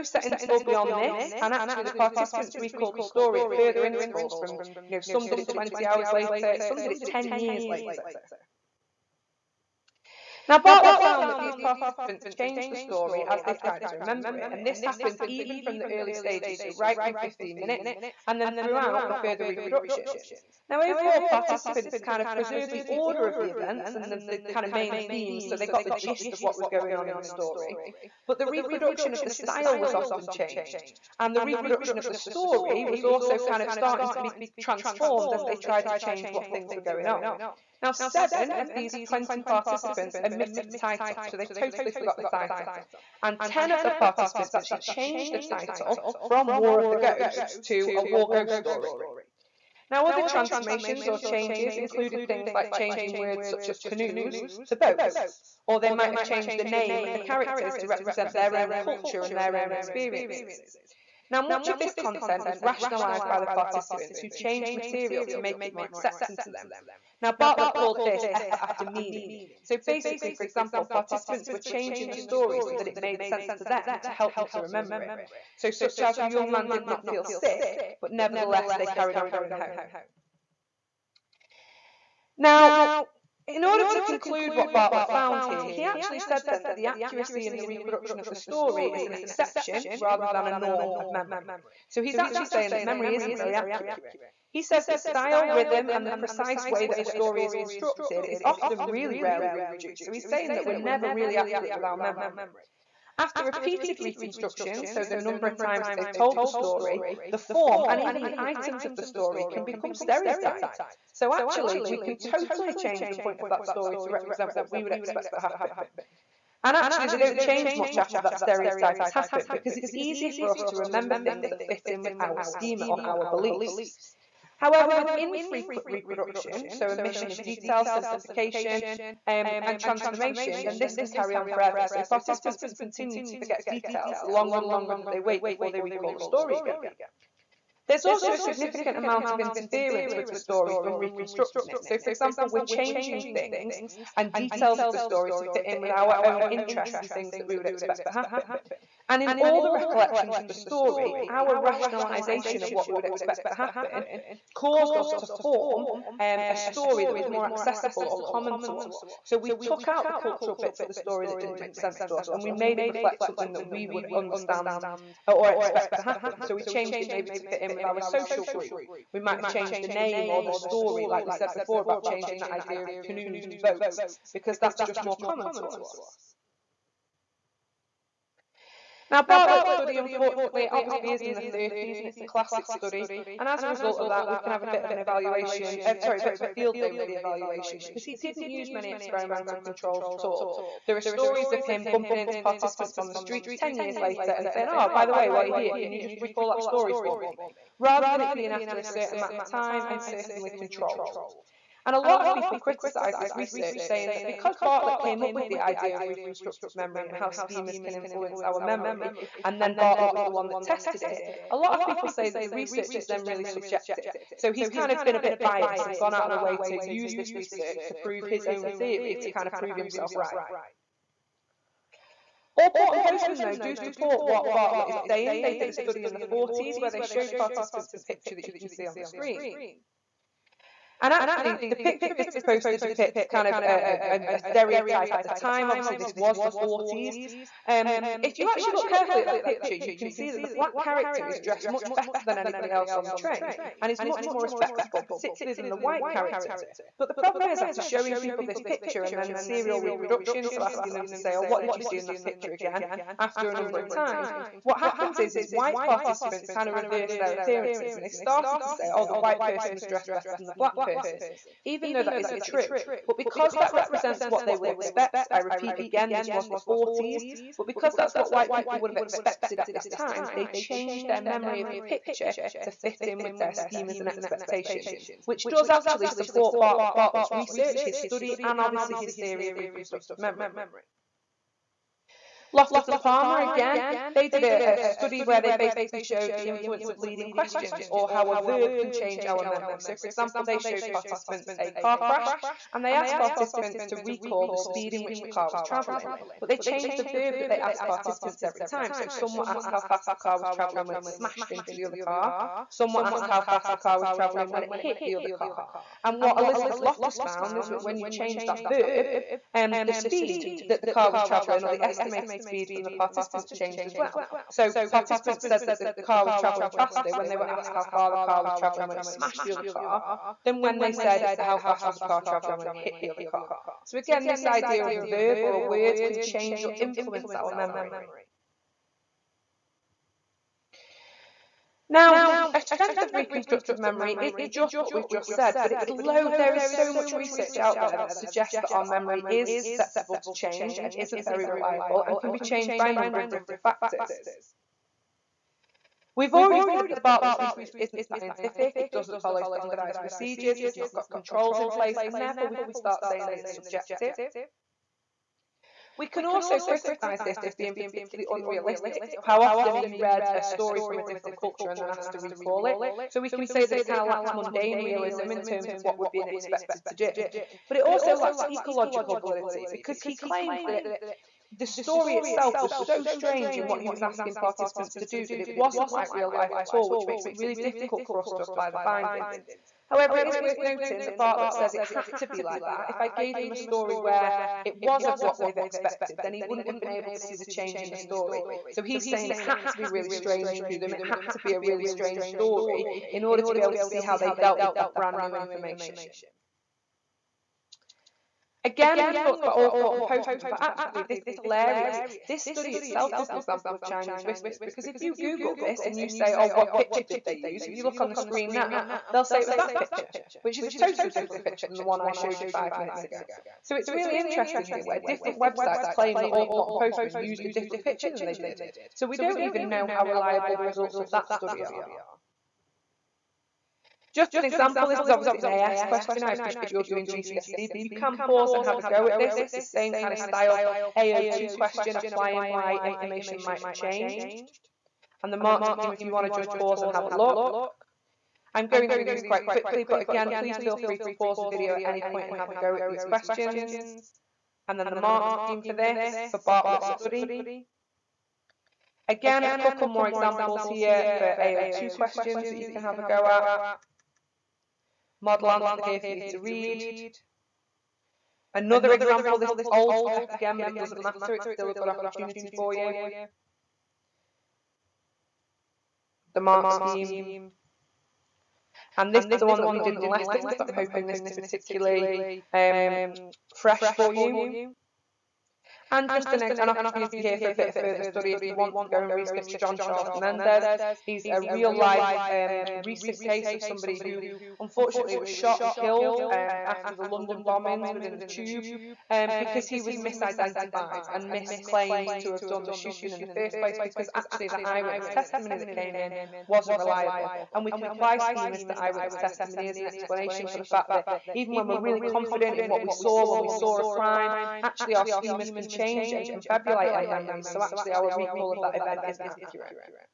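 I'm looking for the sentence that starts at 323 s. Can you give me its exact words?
So again, this idea of a verb or a word can change or influence our memory.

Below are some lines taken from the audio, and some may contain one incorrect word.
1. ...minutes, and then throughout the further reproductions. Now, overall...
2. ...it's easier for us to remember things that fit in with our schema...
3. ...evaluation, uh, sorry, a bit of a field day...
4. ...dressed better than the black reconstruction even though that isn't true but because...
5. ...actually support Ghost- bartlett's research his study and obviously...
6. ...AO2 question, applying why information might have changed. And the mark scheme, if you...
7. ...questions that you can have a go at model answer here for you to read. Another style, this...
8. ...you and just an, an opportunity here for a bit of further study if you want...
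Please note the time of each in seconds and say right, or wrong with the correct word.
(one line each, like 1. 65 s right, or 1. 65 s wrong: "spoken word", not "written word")
1. 17 s right
2. 119 s right
3. 184 s right
4. 259 s wrong: "person", not "reconstruction"
5. 275 s wrong: "Bart", not "Ghost"
6. 430 s right
7. 451 s wrong: "example", not "style"
8. 474 s right.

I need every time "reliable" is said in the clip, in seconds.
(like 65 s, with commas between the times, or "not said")
341 s, 420 s, 496 s.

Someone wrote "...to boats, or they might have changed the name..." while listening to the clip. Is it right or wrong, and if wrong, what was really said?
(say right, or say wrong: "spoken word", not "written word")
right.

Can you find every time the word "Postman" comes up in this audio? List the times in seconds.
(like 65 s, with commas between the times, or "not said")
223 s, 400 s, 416 s.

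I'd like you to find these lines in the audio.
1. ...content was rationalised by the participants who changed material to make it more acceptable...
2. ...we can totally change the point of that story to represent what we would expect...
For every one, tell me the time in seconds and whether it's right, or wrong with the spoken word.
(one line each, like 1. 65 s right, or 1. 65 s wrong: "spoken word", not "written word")
1. 61 s right
2. 111 s right.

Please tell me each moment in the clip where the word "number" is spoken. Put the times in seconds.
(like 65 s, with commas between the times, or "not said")
105 s, 253 s, 342 s.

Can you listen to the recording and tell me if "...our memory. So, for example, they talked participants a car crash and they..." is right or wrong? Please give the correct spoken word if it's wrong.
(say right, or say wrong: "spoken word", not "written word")
wrong: "showed", not "talked".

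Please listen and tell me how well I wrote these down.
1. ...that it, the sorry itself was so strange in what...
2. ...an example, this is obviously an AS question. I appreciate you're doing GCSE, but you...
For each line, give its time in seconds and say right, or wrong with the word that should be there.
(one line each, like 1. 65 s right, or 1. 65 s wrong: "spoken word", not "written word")
1. 370 s wrong: "story", not "sorry"
2. 424 s right.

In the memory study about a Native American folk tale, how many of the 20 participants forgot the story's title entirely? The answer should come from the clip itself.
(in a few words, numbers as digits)
7.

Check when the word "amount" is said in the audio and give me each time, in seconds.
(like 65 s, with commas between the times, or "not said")
138 s, 199 s.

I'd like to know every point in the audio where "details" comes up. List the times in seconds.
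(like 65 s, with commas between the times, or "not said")
127 s, 133 s, 144 s.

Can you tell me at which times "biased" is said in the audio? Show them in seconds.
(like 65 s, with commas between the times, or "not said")
215 s.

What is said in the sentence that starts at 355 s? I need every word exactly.
We can also criticise this for being particularly unrealistic.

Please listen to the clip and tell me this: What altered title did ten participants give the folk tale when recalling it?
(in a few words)
A War Ghost Story.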